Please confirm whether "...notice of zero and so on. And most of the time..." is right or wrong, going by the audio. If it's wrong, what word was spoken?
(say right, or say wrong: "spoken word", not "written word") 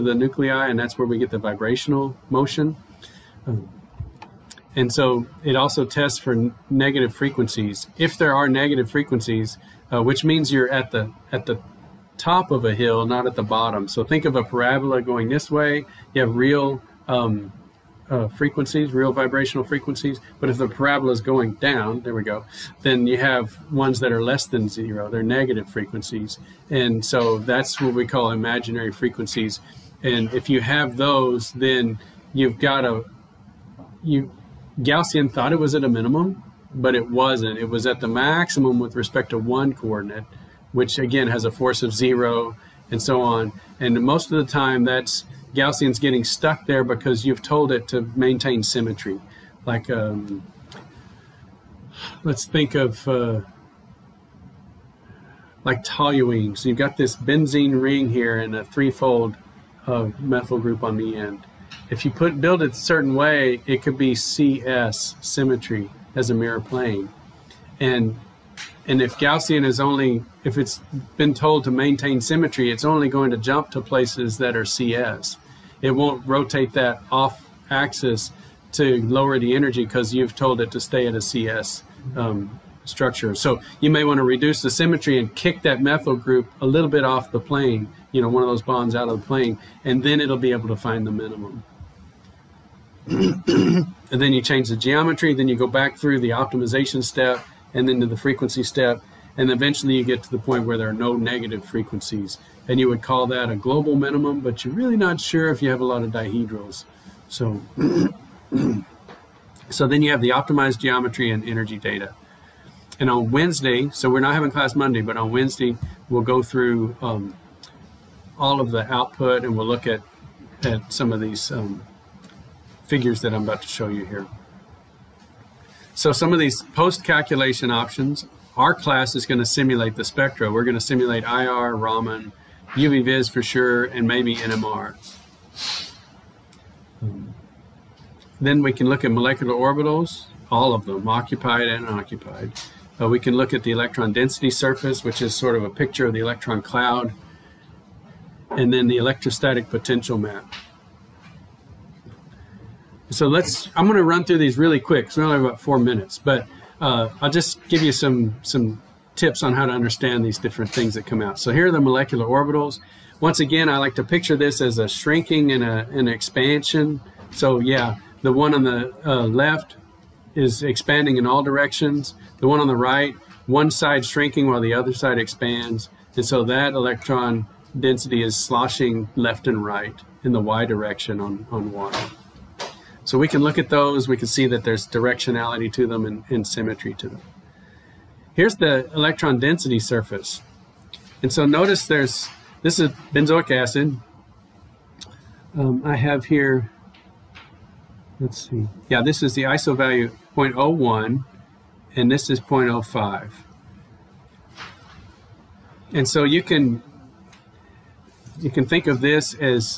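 wrong: "force", not "notice".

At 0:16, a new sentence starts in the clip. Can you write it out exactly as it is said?
You have real um, uh, frequencies, real vibrational frequencies.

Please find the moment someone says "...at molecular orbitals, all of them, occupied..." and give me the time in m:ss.
2:19.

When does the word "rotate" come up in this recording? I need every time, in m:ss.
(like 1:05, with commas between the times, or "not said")
1:16.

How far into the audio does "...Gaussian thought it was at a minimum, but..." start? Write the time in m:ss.
0:34.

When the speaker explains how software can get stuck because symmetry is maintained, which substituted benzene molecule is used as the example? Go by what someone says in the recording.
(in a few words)
toluene.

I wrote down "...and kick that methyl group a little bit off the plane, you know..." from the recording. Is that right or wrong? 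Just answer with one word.
right.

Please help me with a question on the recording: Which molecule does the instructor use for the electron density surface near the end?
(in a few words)
benzoic acid.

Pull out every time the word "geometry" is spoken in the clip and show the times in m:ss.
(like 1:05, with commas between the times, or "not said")
1:34, 1:50.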